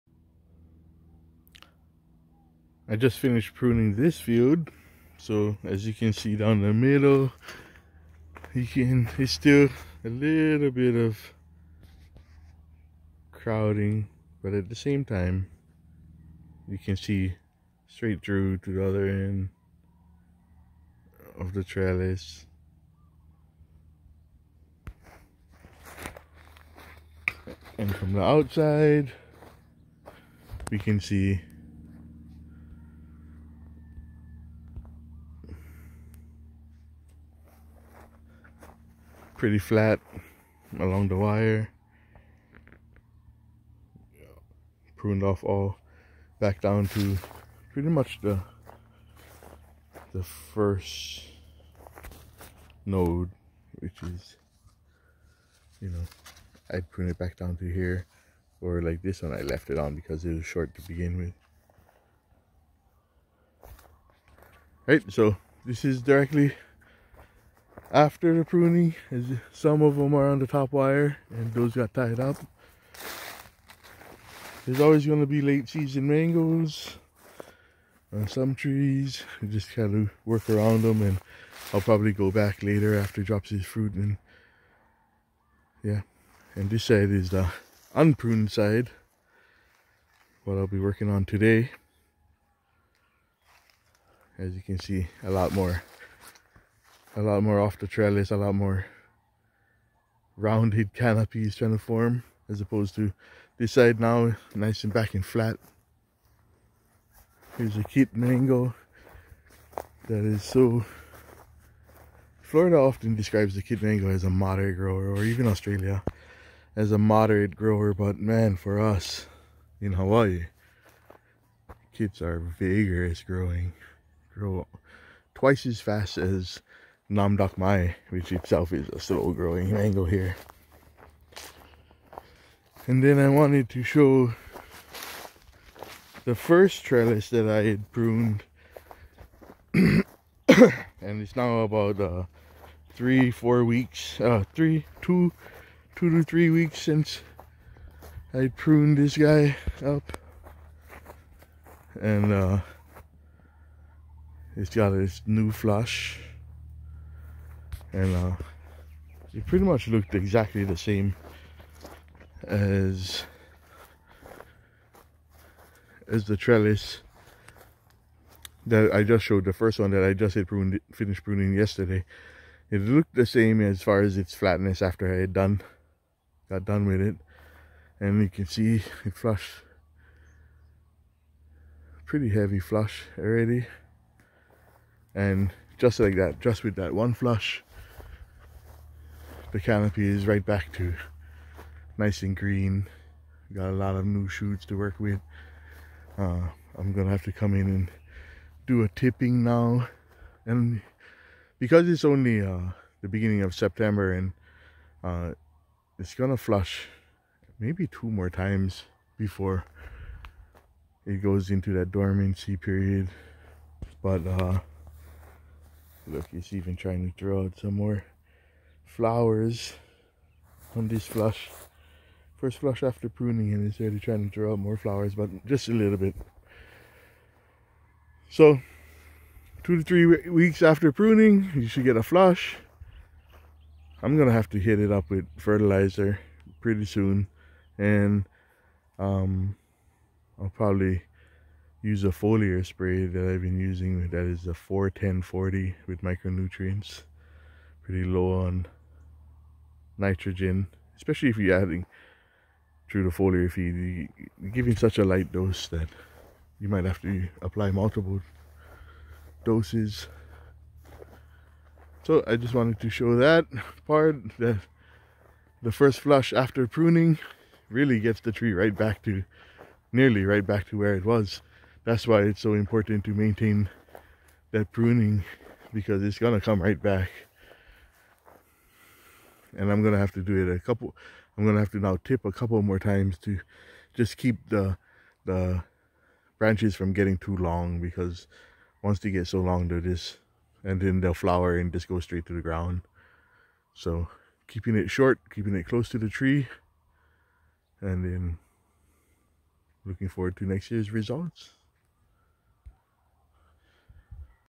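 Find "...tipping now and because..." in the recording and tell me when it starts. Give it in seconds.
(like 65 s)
198 s.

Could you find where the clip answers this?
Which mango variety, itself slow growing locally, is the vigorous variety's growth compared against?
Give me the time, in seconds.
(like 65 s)
127 s.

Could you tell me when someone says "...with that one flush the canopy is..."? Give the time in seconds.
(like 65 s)
186 s.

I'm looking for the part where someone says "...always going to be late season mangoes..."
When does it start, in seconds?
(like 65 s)
74 s.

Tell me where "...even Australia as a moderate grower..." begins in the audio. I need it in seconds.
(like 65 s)
115 s.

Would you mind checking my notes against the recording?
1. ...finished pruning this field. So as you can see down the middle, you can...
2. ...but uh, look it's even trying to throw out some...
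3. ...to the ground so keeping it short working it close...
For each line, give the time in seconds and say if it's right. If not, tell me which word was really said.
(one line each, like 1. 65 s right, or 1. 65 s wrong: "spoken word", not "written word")
1. 3 s right
2. 214 s right
3. 292 s wrong: "keeping", not "working".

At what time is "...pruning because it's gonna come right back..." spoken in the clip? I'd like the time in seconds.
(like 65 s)
274 s.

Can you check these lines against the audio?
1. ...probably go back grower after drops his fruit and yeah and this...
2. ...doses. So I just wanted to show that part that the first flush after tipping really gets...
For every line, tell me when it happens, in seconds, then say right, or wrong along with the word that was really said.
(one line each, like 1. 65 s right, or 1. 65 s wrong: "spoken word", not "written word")
1. 81 s wrong: "later", not "grower"
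2. 259 s wrong: "pruning", not "tipping".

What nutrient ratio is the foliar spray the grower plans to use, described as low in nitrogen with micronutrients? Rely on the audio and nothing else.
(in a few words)
4-10-40.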